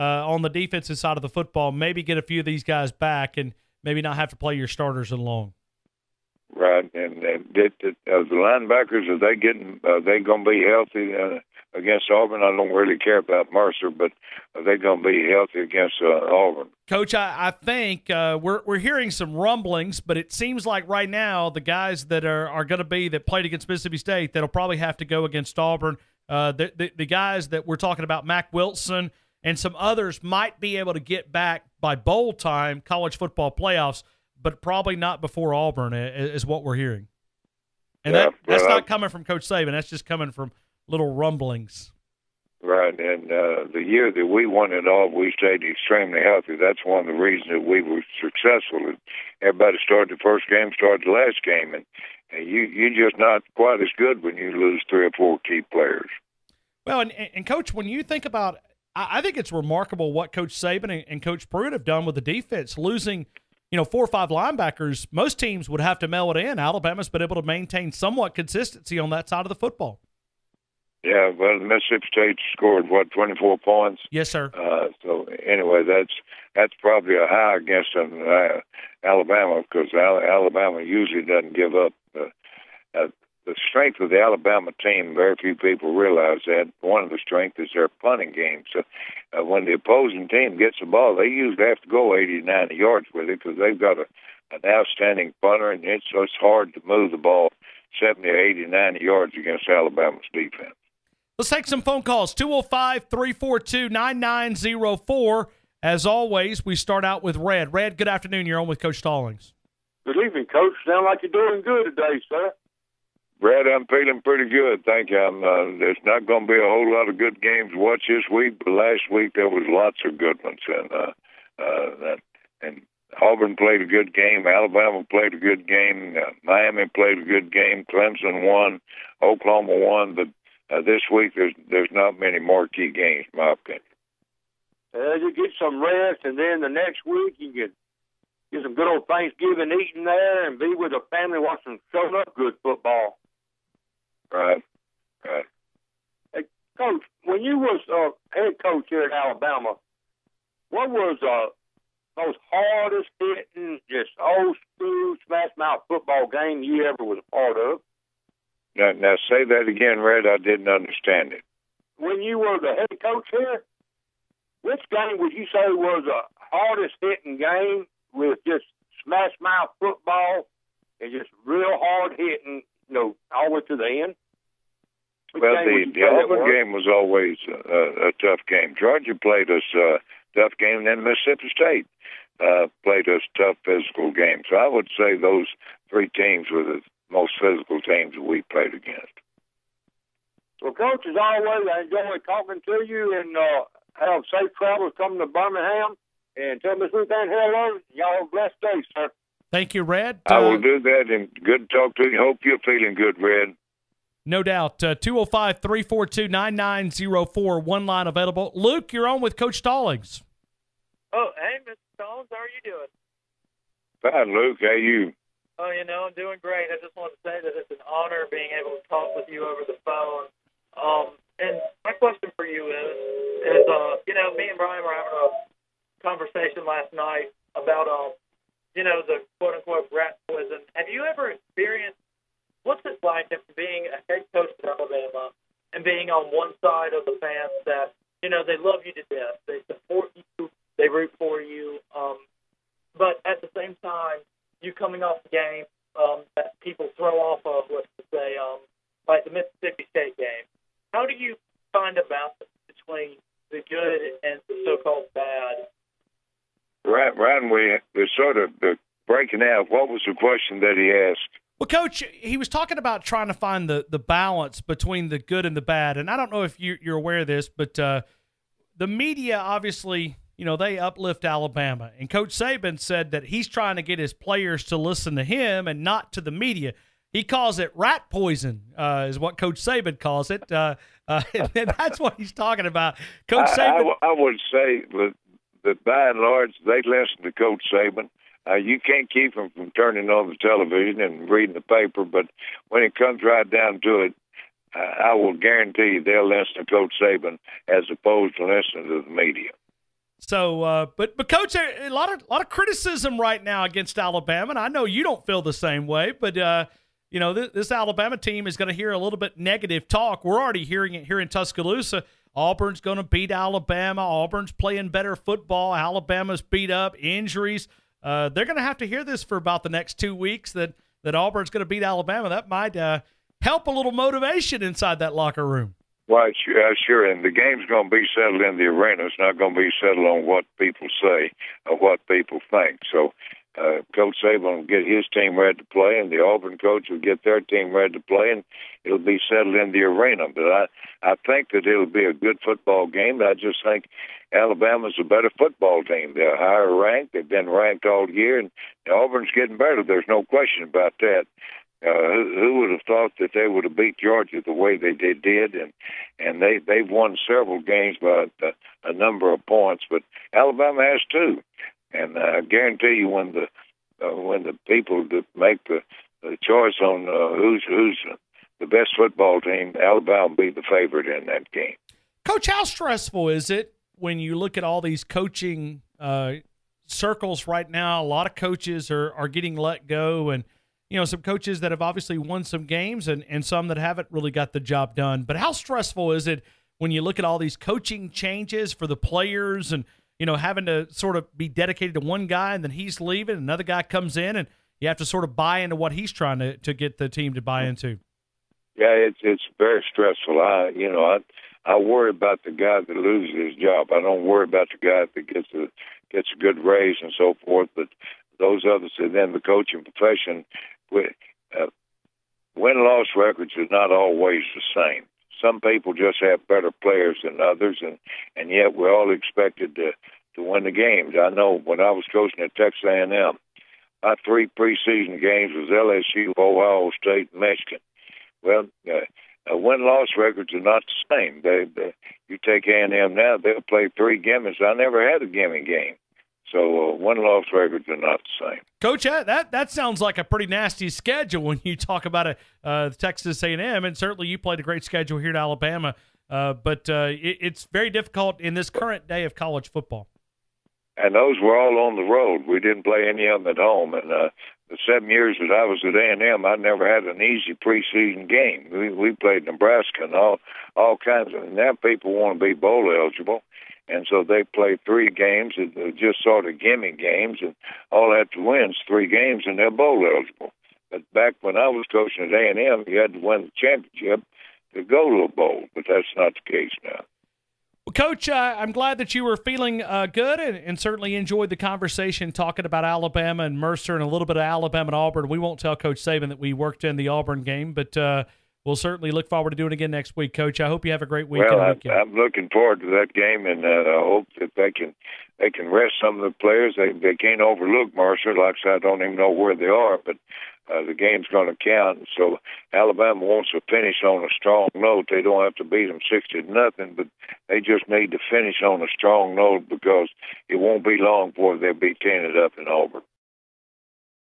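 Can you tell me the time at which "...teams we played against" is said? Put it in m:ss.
3:07.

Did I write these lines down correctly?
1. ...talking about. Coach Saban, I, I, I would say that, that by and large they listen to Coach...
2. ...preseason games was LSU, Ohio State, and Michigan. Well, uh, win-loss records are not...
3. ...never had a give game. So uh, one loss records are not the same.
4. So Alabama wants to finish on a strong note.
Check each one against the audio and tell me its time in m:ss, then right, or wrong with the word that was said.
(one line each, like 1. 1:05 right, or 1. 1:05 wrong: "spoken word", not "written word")
1. 4:42 right
2. 7:04 right
3. 7:14 right
4. 8:22 right.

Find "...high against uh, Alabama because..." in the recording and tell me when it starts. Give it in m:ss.
1:17.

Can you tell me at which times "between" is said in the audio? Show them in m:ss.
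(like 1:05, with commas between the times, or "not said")
4:12, 4:24.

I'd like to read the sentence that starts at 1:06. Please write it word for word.
Alabama's been able to maintain somewhat consistency on that side of the football.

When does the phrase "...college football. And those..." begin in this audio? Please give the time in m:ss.
7:29.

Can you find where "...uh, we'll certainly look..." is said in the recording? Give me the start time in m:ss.
8:07.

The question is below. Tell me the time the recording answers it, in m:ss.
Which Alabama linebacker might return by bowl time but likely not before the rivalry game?
0:28.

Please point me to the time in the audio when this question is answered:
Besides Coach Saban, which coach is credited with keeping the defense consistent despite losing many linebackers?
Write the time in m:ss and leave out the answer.
1:01.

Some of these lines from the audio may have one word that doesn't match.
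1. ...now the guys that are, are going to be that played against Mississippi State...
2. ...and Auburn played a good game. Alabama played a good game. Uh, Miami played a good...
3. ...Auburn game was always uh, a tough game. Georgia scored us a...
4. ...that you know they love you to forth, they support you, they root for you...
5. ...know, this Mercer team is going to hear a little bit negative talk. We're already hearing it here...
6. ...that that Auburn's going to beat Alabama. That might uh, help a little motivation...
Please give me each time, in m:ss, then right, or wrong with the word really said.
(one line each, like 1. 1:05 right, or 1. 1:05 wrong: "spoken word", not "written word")
1. 0:21 right
2. 2:02 right
3. 2:56 wrong: "played", not "scored"
4. 3:57 wrong: "death", not "forth"
5. 5:07 wrong: "Alabama", not "Mercer"
6. 5:20 right.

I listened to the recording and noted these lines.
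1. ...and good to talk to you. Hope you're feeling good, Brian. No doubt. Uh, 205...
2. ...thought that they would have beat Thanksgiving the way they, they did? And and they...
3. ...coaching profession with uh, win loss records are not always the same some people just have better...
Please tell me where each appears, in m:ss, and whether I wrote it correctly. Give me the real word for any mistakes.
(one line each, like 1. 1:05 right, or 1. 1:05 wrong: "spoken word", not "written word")
1. 3:21 wrong: "Red", not "Brian"
2. 5:52 wrong: "Georgia", not "Thanksgiving"
3. 6:49 right.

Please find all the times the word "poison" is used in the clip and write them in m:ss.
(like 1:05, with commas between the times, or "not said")
3:50, 4:38.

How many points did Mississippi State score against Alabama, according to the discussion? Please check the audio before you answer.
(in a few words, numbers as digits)
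24.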